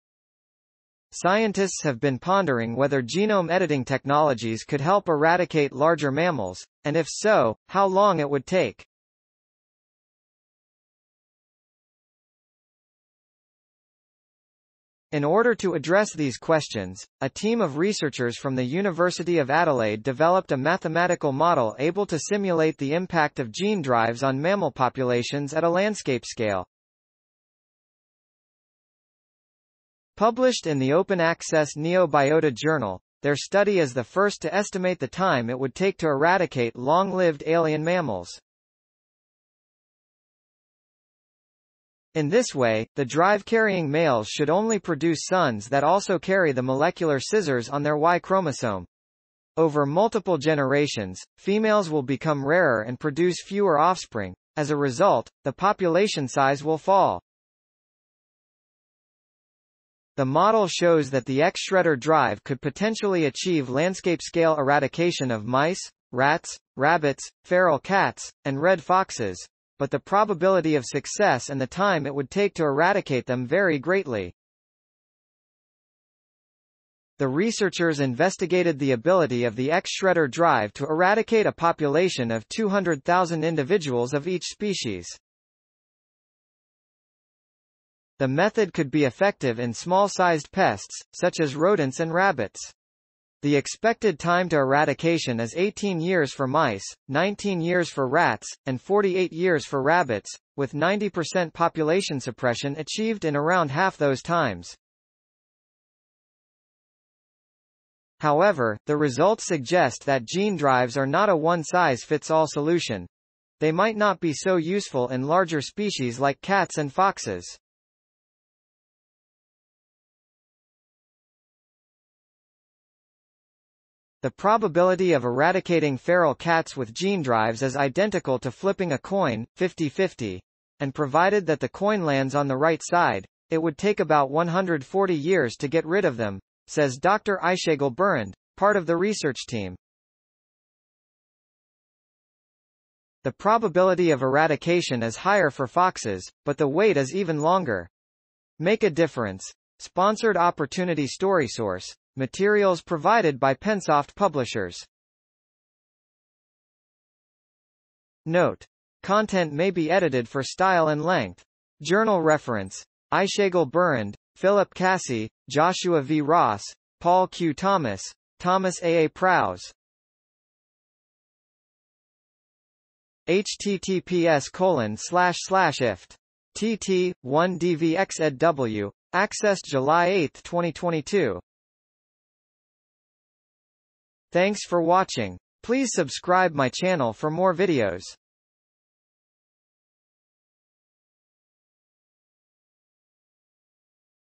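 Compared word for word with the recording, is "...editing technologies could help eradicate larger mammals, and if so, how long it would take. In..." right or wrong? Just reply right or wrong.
right.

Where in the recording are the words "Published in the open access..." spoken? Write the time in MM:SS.
00:30.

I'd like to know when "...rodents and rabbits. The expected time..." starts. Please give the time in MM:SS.
01:31.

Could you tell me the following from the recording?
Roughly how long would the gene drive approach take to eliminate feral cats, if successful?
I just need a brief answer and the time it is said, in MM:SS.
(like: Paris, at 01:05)
140 years, at 02:14.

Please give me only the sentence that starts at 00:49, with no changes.
Over multiple generations, females will become rarer and produce fewer offspring.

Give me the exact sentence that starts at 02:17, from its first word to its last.
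Aysegul Birand, part of the research team.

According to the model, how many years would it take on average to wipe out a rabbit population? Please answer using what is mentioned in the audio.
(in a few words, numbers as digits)
48 years.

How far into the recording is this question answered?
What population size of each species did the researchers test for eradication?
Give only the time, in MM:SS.
01:22.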